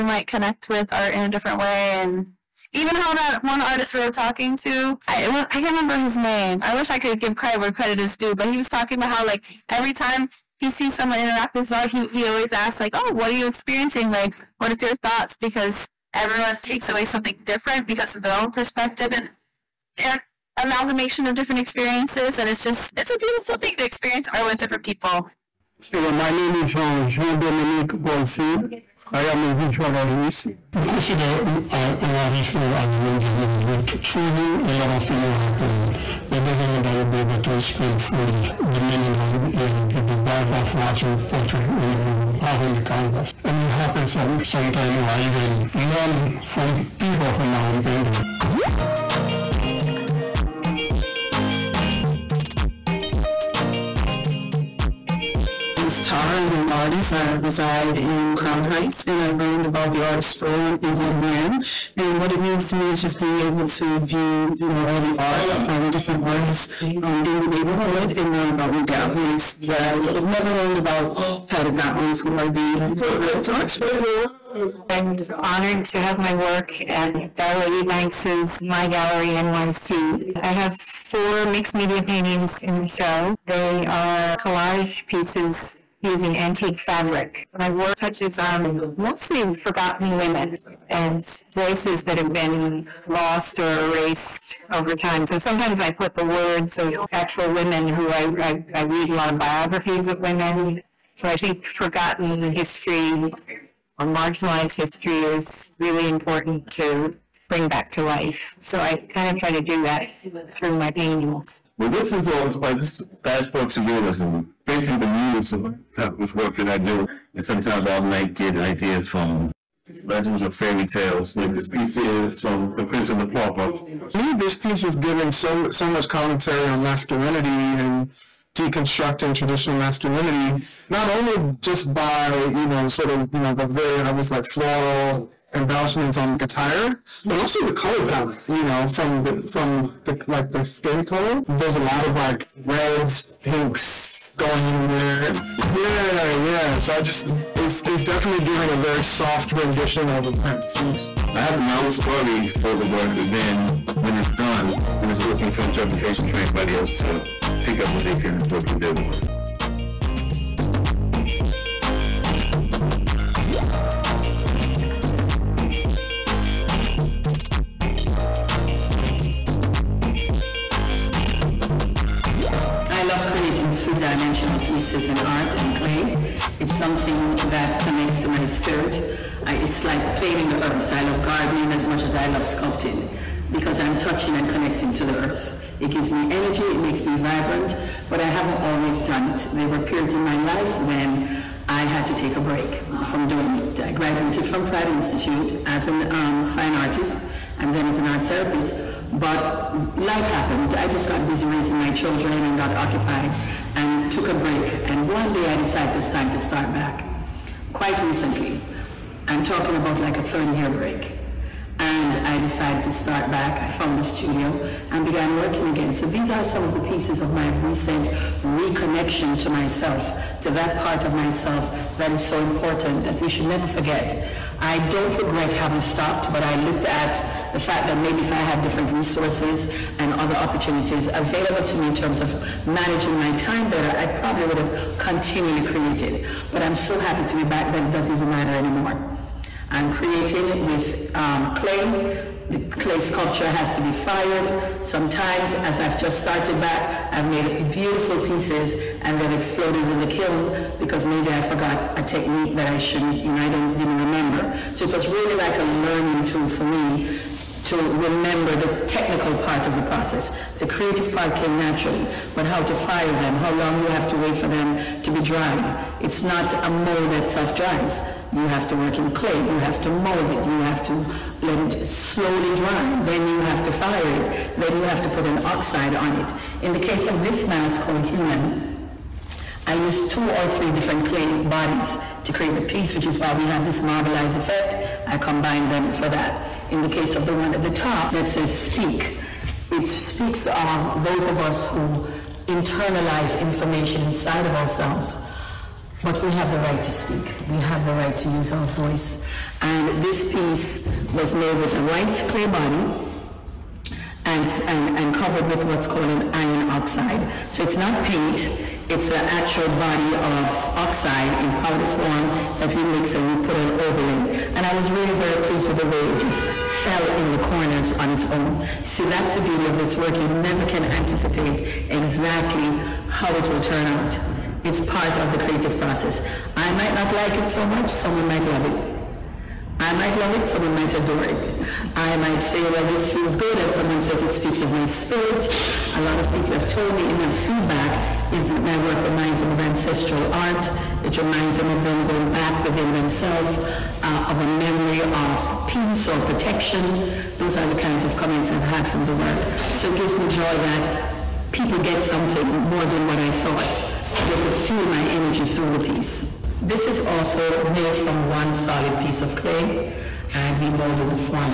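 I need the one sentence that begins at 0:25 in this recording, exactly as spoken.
Hello, my name is Jean Dominique Bolsi.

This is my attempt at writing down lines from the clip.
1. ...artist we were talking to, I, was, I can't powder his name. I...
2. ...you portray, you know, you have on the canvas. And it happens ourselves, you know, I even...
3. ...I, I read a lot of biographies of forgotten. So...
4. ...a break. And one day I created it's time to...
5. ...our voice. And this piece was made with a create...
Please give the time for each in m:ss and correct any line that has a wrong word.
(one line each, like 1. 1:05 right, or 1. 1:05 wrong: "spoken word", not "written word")
1. 0:03 wrong: "remember", not "powder"
2. 0:41 wrong: "sometimes", not "ourselves"
3. 1:38 wrong: "women", not "forgotten"
4. 3:24 wrong: "decided", not "created"
5. 4:58 wrong: "white", not "create".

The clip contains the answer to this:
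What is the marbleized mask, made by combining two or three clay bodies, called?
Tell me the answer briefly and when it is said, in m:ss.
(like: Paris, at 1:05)
Human, at 4:38.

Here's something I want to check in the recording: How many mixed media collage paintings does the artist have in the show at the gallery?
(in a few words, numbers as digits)
4.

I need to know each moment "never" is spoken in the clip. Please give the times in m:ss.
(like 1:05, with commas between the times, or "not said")
1:10, 3:43, 5:20.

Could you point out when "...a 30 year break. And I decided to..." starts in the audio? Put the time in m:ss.
3:30.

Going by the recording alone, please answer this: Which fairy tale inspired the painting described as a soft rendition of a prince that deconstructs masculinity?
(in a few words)
The Prince and the Pauper.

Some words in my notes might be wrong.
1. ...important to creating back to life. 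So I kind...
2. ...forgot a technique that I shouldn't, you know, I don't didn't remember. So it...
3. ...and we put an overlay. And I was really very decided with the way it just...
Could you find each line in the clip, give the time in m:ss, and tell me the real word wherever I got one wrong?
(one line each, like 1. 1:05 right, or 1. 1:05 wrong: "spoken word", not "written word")
1. 1:46 wrong: "bring", not "creating"
2. 4:11 right
3. 5:13 wrong: "pleased", not "decided".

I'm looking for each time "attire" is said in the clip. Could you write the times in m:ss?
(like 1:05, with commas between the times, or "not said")
2:16.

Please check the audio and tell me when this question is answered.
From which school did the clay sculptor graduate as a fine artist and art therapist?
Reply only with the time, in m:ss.
3:14.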